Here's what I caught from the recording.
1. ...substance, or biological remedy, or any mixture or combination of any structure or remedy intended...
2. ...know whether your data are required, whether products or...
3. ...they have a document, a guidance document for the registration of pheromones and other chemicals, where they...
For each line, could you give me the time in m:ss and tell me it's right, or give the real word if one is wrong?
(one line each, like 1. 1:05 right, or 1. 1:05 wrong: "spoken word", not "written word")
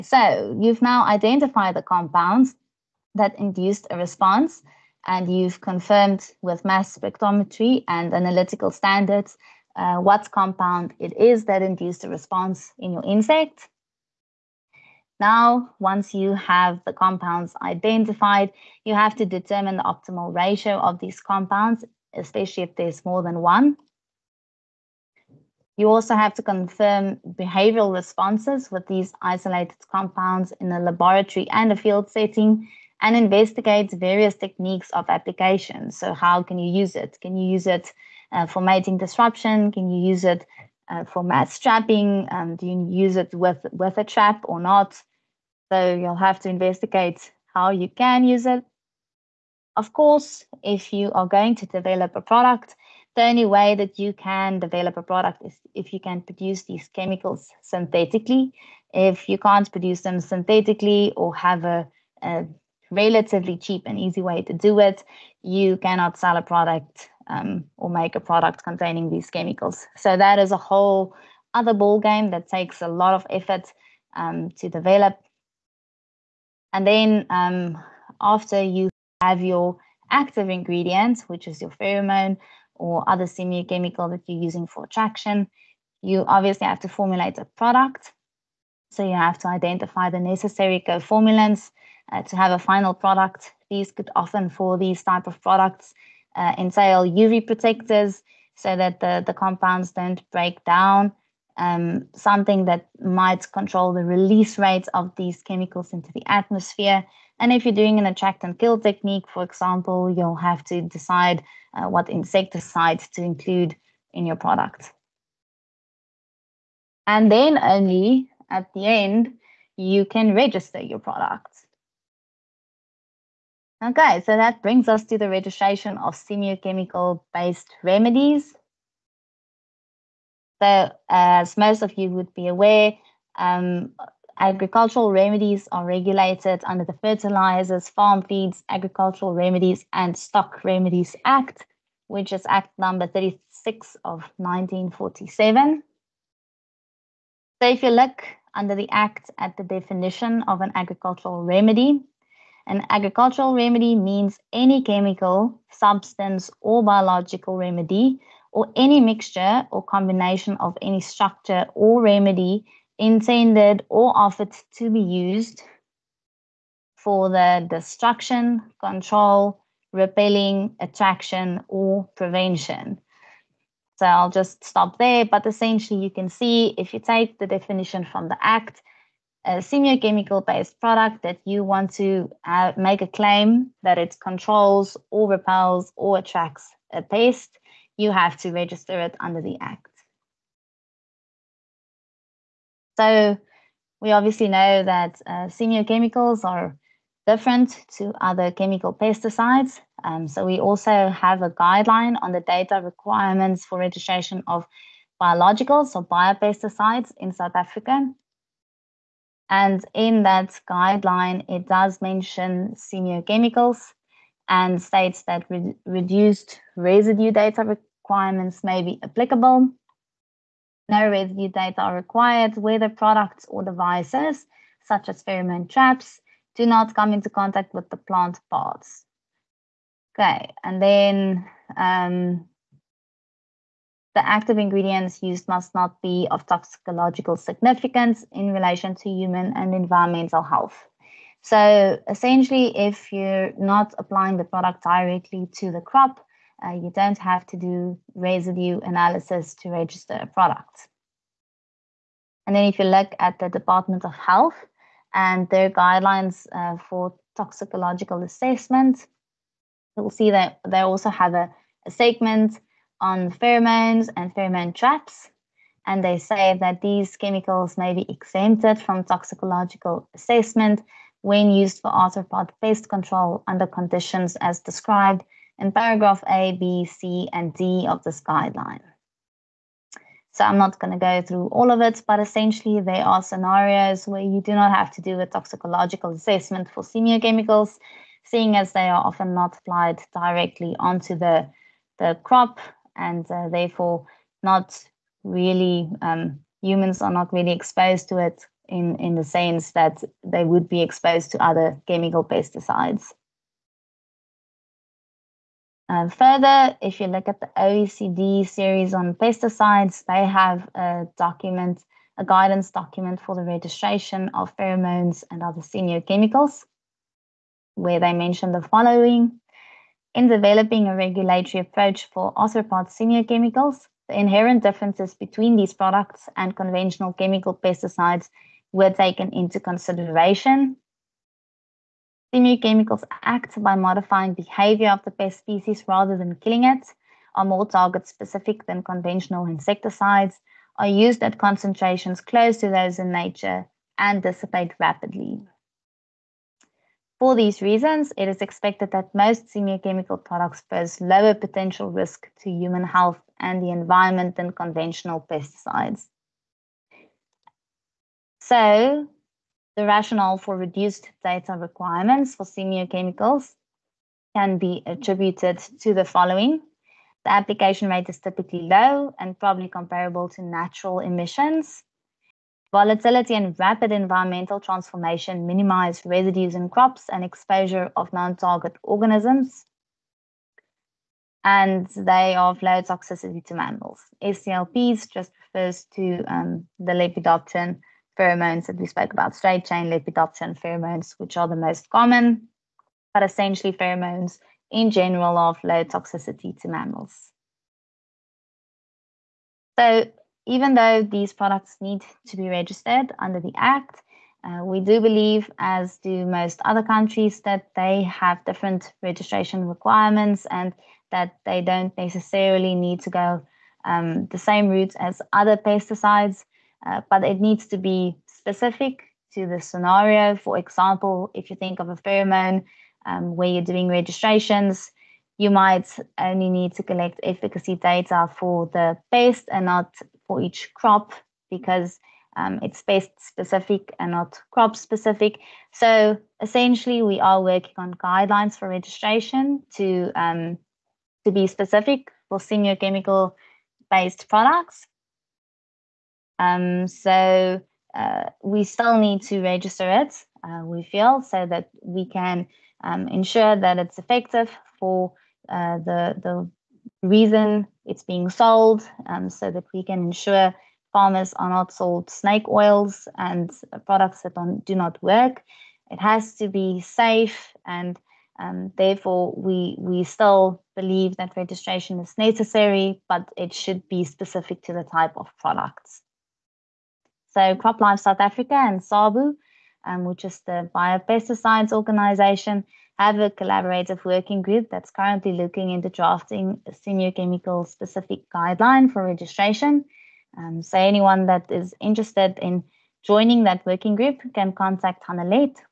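1. 2:35 right
2. 3:40 right
3. 5:10 right.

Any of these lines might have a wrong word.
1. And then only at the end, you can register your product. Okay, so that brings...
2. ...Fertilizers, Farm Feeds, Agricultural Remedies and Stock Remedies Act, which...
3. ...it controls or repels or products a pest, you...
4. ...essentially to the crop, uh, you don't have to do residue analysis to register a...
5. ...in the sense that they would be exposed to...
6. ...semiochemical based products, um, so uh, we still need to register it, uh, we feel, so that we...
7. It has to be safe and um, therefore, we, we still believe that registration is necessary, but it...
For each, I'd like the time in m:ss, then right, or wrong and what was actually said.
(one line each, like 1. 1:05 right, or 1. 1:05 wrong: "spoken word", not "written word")
1. 1:57 right
2. 2:17 right
3. 3:03 wrong: "attracts", not "products"
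4. 4:04 wrong: "directly", not "essentially"
5. 4:58 right
6. 7:22 right
7. 7:45 right.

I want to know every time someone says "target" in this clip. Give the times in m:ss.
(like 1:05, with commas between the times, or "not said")
5:37, 6:18.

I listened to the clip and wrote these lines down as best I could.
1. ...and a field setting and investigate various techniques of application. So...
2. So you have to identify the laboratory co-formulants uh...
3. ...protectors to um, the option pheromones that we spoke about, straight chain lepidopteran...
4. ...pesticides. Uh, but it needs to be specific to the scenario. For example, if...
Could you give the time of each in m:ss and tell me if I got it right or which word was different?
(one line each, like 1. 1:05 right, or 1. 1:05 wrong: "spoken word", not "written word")
1. 0:31 right
2. 1:28 wrong: "necessary", not "laboratory"
3. 6:25 wrong: "refers", not "protectors"
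4. 6:55 right.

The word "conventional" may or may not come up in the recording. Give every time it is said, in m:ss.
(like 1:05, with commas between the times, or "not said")
5:26, 5:38, 5:54.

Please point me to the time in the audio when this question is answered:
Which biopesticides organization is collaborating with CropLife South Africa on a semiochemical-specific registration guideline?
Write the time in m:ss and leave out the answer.
7:58.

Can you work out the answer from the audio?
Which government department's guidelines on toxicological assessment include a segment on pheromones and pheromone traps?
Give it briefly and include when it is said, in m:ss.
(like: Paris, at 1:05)
Department of Health, at 4:13.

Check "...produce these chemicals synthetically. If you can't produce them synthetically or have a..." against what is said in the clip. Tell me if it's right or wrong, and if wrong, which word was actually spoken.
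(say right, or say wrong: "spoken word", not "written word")
right.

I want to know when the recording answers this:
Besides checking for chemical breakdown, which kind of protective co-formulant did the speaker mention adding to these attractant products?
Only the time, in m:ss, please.
1:37.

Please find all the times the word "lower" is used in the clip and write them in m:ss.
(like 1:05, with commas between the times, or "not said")
5:51.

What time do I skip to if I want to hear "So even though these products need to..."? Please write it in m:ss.
6:39.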